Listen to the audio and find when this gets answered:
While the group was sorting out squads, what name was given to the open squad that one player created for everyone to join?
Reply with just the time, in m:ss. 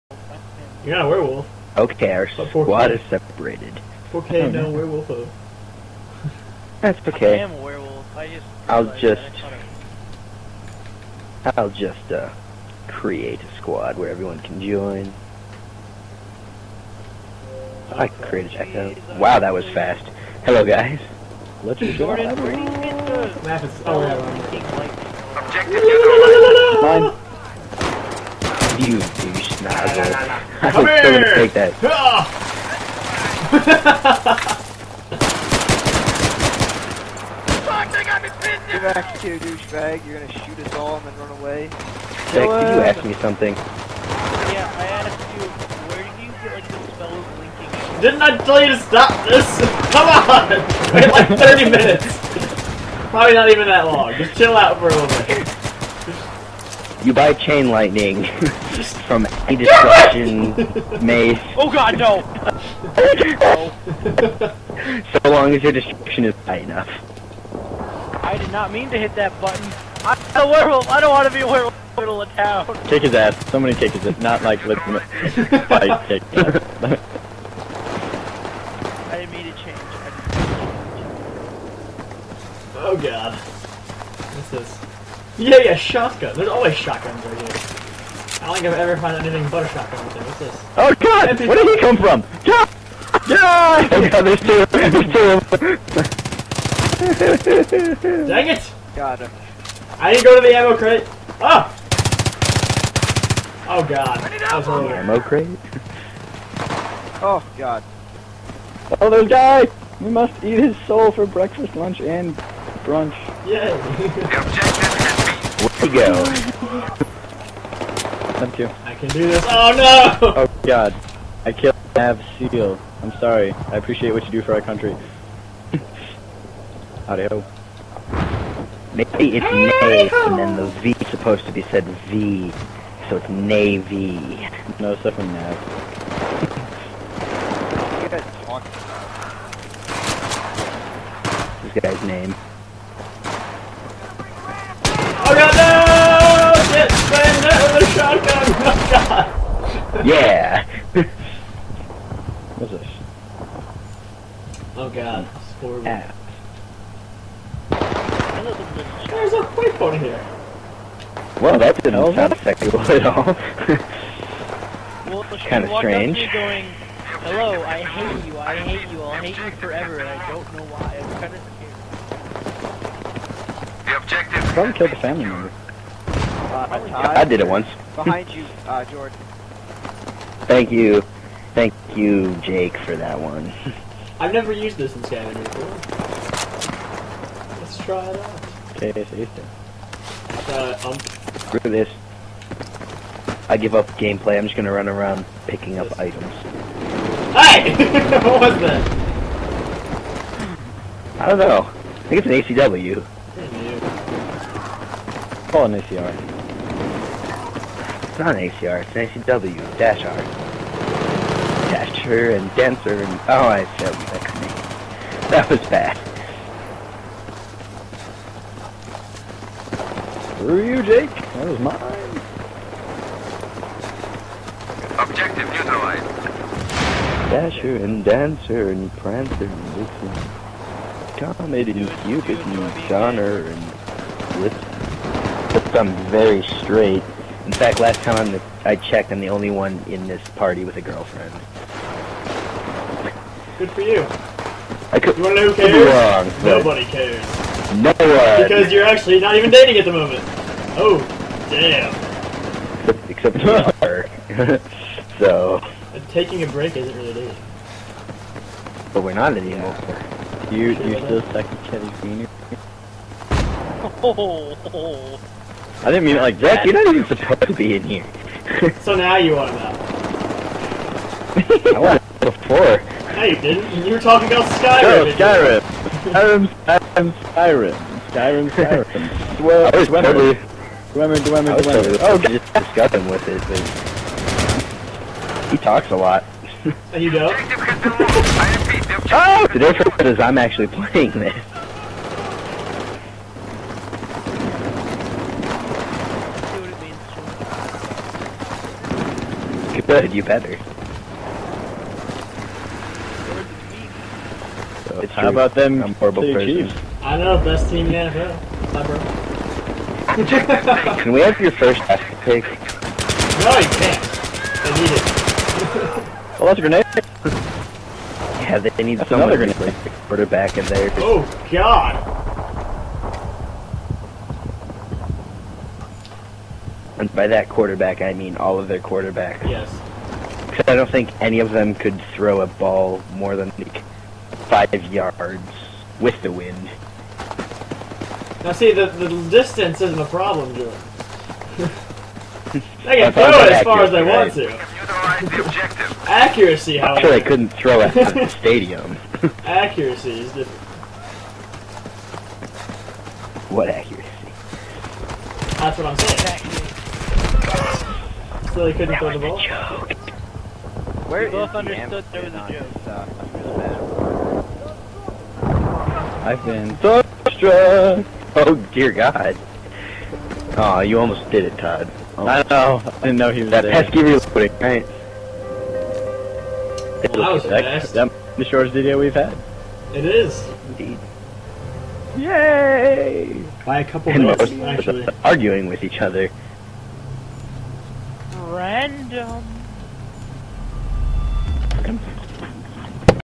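0:17.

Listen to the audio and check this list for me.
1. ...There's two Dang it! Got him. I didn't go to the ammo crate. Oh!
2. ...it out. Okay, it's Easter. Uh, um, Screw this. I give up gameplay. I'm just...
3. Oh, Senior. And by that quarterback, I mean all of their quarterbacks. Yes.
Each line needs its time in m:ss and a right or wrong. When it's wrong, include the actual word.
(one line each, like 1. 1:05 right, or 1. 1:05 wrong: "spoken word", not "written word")
1. 1:37 right
2. 3:08 right
3. 5:20 wrong: "God", not "Senior".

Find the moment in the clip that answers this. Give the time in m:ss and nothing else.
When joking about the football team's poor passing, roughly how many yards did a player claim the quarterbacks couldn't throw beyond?
5:34.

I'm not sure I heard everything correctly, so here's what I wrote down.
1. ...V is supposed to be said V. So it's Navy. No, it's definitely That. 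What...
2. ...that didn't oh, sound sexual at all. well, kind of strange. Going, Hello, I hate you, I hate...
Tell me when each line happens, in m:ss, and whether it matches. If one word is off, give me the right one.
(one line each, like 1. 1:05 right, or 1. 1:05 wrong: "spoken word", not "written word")
1. 2:10 wrong: "Nav", not "That"
2. 2:41 right.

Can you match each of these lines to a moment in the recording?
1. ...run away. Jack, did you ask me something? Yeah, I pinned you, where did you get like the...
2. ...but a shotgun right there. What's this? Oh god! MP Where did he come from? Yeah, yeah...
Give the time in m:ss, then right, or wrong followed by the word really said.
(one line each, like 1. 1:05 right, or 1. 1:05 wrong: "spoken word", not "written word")
1. 0:41 wrong: "asked", not "pinned"
2. 1:29 right.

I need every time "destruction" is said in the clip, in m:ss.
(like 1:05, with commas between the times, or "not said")
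0:59, 1:05.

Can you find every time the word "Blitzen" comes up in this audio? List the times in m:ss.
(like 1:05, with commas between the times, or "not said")
3:49, 3:54.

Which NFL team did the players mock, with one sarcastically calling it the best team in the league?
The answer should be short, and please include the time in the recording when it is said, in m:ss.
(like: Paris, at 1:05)
Chiefs, at 5:06.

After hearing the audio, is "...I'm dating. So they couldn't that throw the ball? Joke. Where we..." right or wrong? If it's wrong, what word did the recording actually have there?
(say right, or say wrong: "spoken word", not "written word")
wrong: "saying", not "dating".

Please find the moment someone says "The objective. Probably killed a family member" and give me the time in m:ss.
2:53.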